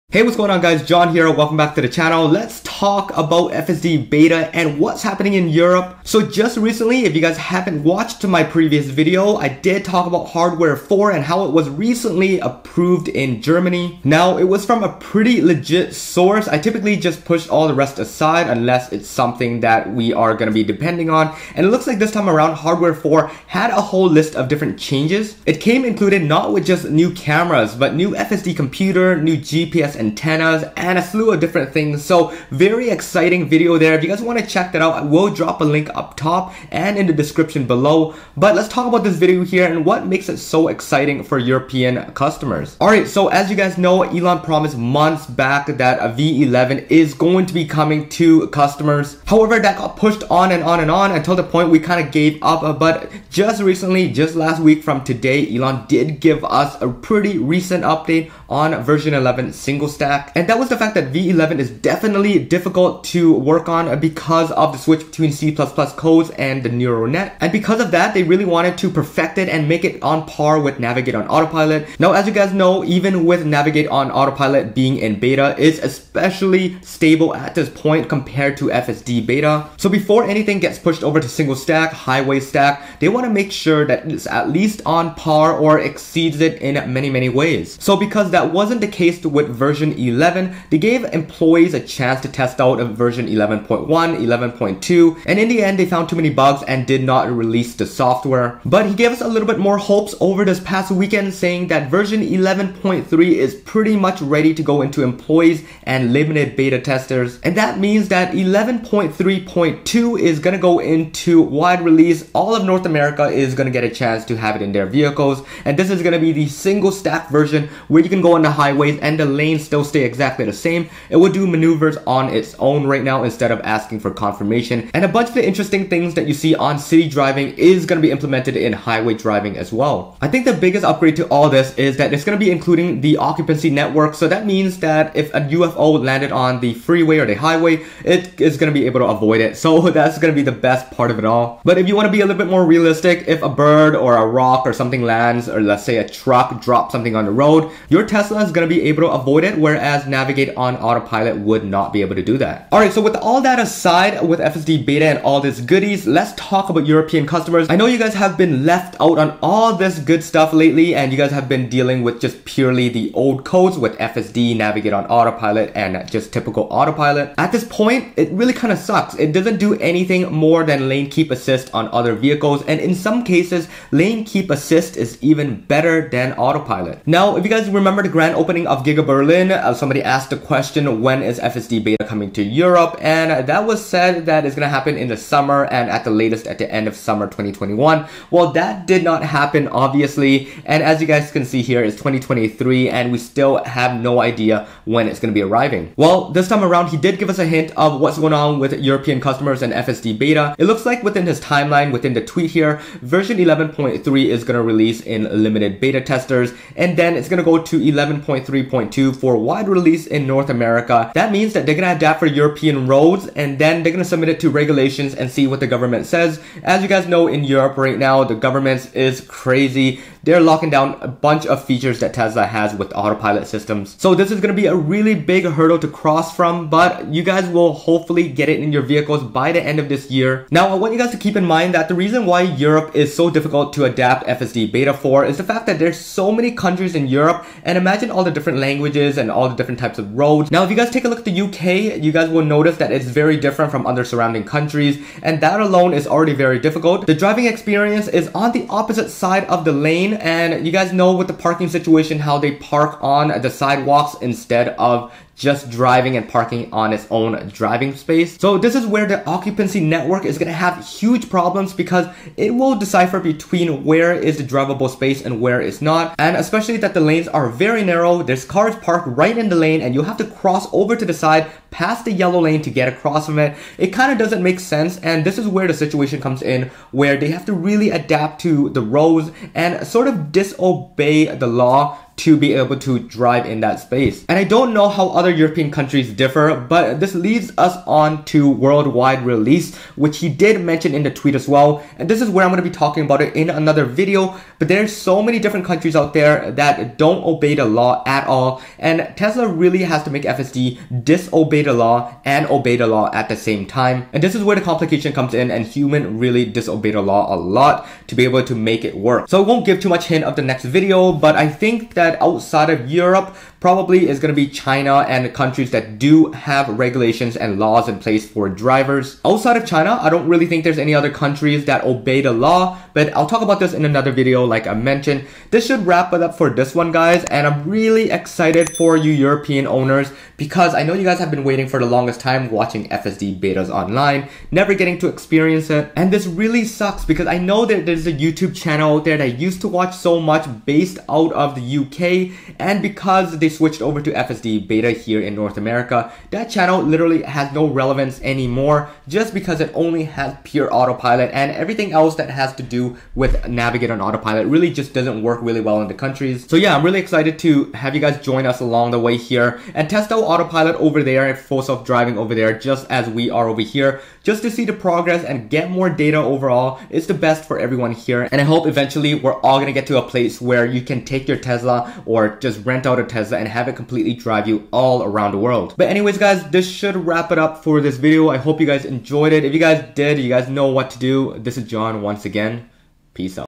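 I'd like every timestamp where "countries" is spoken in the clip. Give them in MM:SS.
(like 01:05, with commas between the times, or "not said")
03:56, 04:04, 04:45, 04:55, 05:15, 05:21, 05:55.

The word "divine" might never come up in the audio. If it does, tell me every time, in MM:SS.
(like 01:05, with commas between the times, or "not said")
not said.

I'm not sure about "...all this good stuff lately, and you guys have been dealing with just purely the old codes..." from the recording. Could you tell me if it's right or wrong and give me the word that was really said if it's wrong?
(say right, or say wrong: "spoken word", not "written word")
right.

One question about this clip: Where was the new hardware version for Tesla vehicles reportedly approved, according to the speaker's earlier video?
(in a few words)
Germany.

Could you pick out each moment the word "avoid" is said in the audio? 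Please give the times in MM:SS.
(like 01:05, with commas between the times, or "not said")
02:19, 02:29.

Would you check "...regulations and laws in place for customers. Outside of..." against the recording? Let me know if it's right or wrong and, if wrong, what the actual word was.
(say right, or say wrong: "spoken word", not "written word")
wrong: "drivers", not "customers".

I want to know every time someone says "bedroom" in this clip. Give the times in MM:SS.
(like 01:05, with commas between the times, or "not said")
not said.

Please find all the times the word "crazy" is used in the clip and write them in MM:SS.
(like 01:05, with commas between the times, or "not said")
03:39.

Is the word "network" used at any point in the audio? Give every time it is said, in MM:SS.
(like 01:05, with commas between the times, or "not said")
02:13, 04:19.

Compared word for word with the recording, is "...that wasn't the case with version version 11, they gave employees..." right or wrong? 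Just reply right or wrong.
right.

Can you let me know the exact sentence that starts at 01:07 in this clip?
And because of that, they really wanted to perfect it and make it on par with Navigate on Autopilot.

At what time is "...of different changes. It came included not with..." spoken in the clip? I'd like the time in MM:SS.
00:24.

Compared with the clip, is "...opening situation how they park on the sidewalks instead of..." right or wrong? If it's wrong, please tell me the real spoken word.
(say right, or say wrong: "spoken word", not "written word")
wrong: "parking", not "opening".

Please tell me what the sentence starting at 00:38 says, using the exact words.
But let's talk about this video here and what makes it so exciting for European customers.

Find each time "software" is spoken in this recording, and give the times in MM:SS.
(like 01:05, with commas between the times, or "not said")
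01:37.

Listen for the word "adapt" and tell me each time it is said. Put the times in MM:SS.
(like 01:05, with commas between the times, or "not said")
03:31, 03:53, 04:37.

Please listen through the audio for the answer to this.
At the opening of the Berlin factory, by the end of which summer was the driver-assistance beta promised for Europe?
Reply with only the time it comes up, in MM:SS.
03:06.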